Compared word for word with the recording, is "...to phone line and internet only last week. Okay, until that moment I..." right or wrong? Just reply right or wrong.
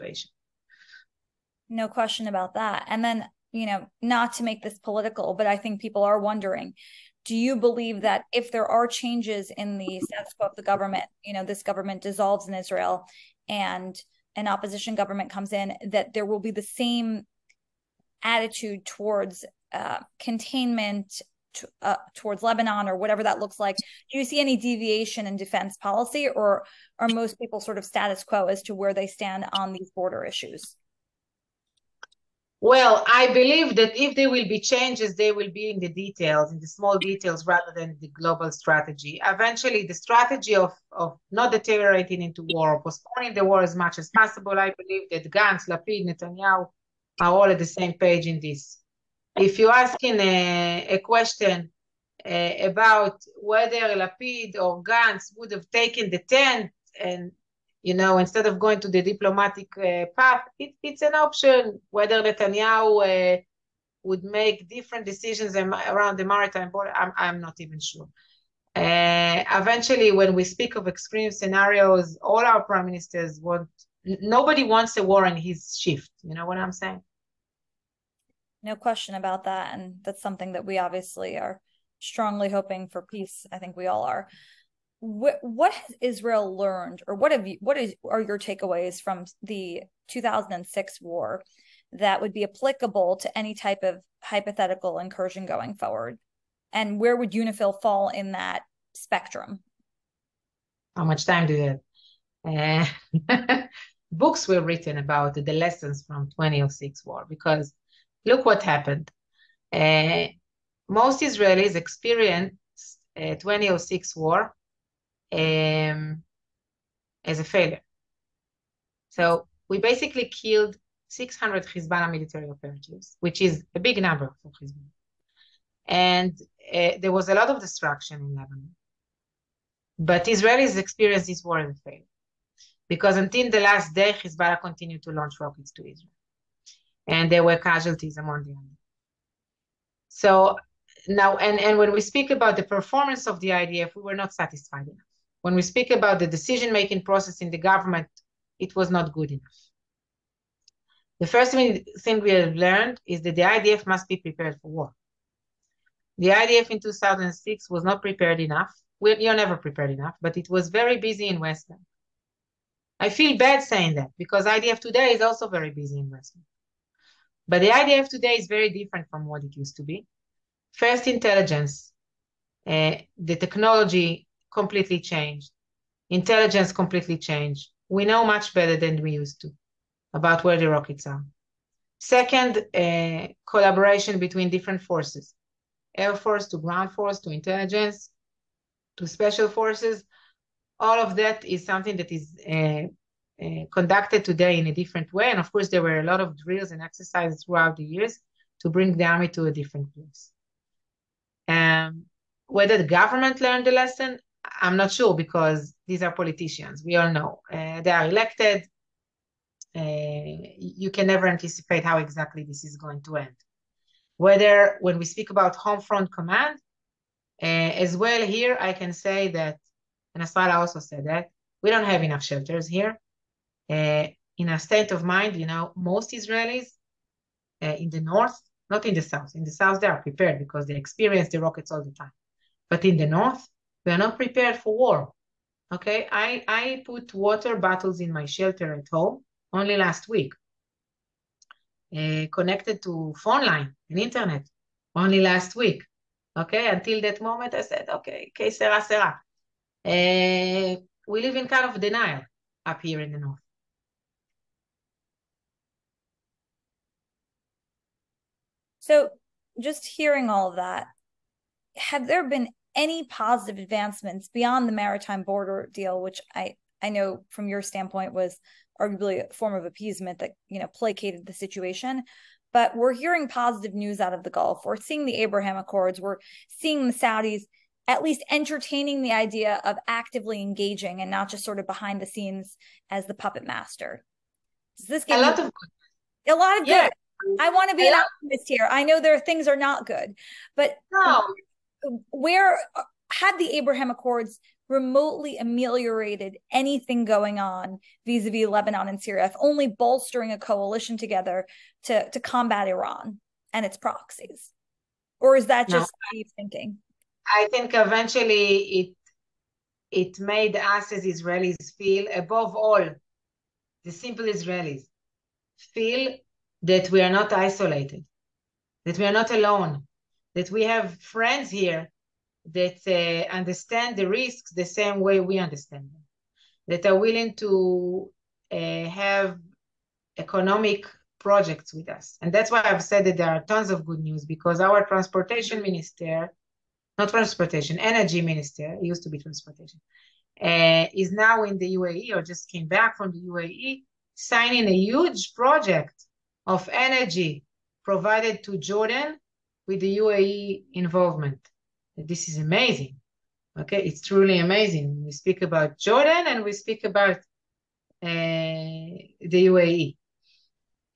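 right.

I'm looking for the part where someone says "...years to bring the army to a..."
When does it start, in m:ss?
3:17.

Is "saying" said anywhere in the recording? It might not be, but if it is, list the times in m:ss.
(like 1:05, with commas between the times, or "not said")
1:16, 2:43.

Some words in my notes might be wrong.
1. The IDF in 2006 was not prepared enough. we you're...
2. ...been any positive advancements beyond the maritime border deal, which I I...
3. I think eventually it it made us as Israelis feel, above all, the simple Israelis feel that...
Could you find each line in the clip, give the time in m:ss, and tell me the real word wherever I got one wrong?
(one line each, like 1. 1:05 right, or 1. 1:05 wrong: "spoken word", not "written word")
1. 2:36 right
2. 4:22 right
3. 5:07 right.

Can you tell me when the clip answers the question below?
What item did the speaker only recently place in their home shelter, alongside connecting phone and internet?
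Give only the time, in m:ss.
3:57.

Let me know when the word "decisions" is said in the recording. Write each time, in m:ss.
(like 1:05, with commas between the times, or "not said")
1:05, 2:26.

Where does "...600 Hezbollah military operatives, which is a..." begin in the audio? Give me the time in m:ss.
2:01.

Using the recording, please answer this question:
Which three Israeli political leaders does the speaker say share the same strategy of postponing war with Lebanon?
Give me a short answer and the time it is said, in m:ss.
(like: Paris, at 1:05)
Gantz, Lapid, Netanyahu, at 0:45.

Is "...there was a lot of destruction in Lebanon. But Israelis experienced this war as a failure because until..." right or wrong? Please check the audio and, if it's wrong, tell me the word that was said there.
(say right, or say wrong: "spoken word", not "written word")
right.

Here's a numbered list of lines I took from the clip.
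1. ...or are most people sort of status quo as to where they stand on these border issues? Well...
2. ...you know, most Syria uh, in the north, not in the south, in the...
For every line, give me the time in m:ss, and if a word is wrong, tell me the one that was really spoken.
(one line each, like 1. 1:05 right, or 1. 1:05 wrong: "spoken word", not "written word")
1. 0:26 right
2. 3:45 wrong: "Israelis", not "Syria".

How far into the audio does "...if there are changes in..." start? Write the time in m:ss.
0:08.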